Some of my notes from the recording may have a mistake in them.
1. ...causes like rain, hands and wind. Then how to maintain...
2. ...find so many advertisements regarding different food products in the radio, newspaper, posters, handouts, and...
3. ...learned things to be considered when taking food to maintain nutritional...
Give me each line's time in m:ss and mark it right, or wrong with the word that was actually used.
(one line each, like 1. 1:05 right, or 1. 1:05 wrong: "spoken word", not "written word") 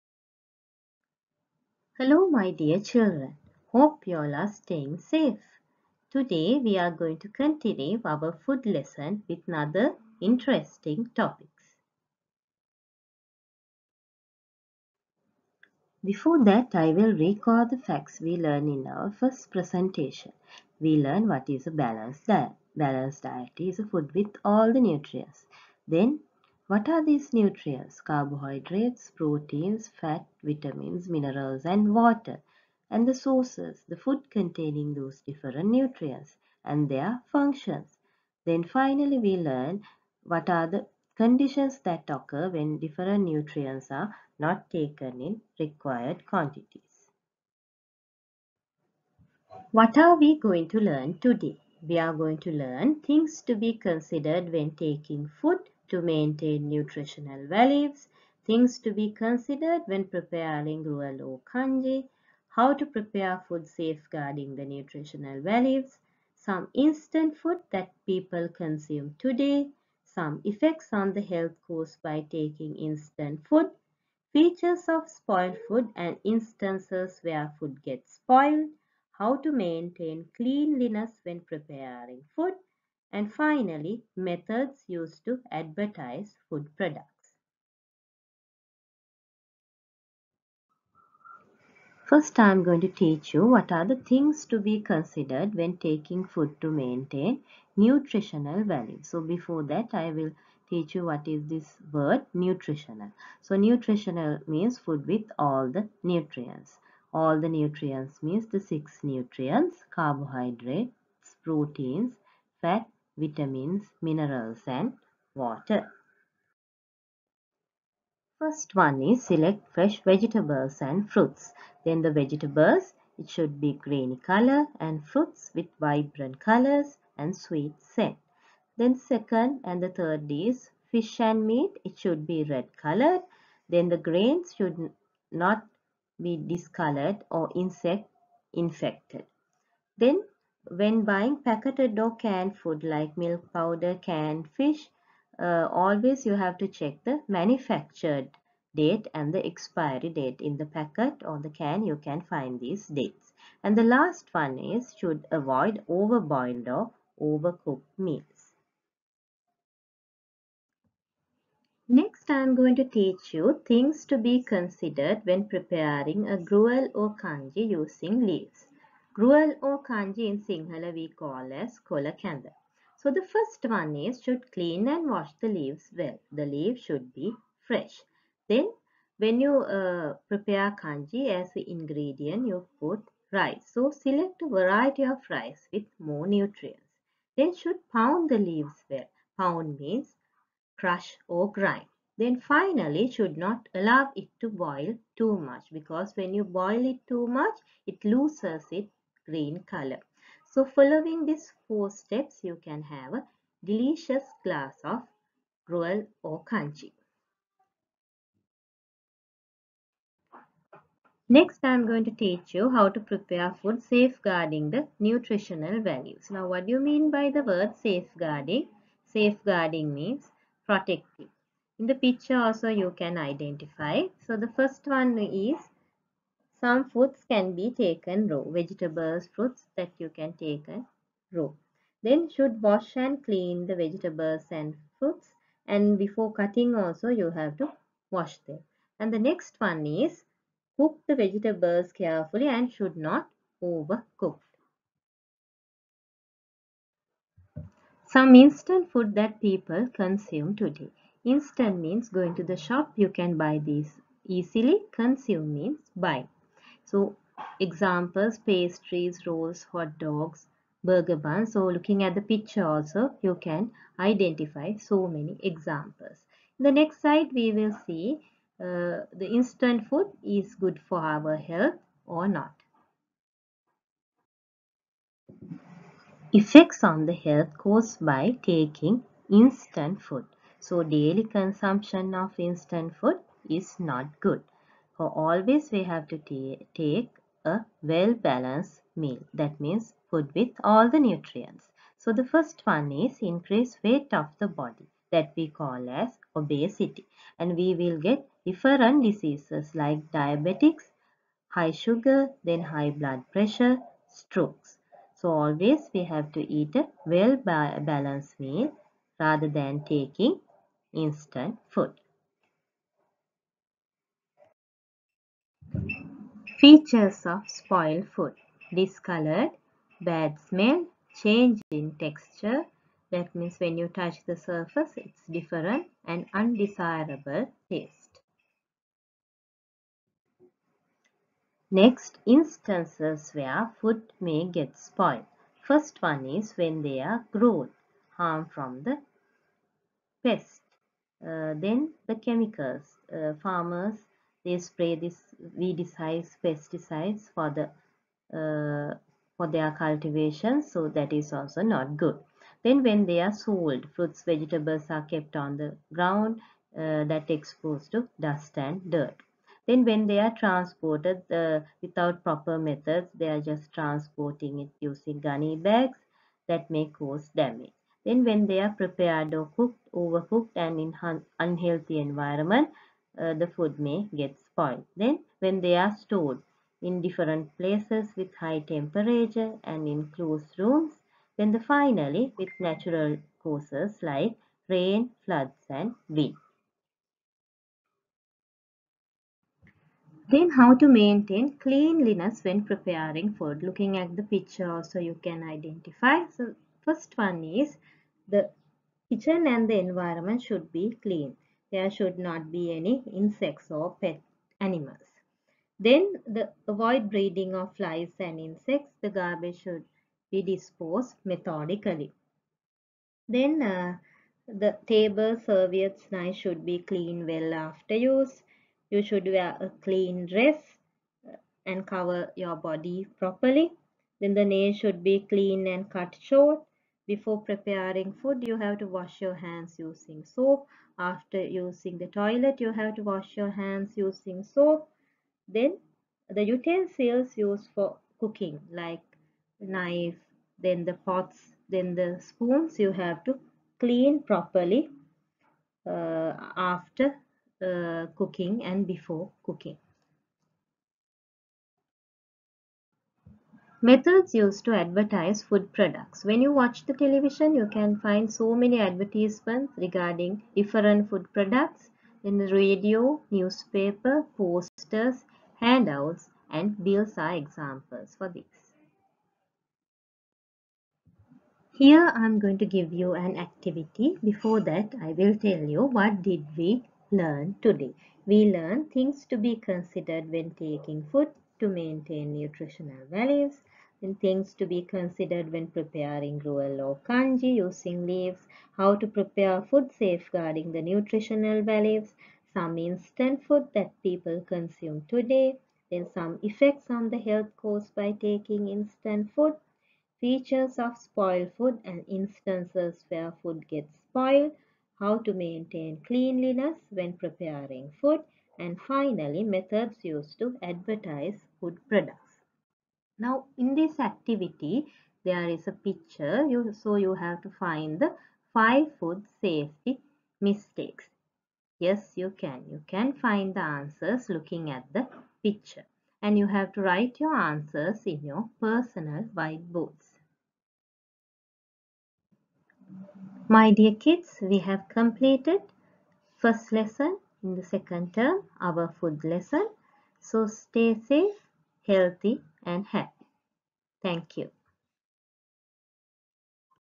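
1. 6:23 wrong: "floods", not "hands"
2. 7:37 right
3. 7:58 right.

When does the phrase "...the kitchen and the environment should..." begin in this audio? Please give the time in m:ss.
6:38.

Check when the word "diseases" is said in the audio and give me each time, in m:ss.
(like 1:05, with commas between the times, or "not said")
4:59.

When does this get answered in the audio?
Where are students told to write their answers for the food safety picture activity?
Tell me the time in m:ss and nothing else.
8:48.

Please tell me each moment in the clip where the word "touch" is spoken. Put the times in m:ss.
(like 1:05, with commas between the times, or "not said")
5:23.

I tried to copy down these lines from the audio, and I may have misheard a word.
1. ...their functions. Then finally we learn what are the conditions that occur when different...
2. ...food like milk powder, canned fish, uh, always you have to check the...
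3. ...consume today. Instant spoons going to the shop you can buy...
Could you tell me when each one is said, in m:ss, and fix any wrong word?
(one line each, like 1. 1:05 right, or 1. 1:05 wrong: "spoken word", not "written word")
1. 0:36 right
2. 2:22 right
3. 4:09 wrong: "means", not "spoons".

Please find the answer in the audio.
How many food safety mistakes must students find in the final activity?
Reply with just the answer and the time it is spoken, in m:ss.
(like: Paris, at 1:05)
5, at 8:38.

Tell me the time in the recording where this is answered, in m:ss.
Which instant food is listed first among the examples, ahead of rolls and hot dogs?
4:18.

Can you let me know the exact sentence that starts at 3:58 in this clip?
And the next one is cook the vegetables carefully and should not overcook.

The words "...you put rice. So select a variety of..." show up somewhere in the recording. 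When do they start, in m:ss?
3:02.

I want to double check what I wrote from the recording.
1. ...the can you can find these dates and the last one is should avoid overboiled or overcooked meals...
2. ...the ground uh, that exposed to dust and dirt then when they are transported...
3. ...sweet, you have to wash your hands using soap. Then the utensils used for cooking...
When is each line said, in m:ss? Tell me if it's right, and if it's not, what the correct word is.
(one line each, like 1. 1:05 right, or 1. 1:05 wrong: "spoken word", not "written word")
1. 2:31 right
2. 5:55 right
3. 7:12 wrong: "toilet", not "sweet".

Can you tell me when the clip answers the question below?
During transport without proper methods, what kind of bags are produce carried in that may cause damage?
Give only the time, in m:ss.
6:05.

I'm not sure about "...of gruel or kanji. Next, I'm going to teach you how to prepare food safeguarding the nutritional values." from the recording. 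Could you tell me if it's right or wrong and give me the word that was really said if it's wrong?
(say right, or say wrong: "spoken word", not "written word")
right.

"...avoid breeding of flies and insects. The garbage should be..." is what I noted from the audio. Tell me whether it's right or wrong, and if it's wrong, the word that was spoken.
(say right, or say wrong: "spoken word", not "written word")
right.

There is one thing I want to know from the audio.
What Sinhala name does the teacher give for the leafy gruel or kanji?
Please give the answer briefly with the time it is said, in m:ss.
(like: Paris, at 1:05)
Kolakanda, at 2:51.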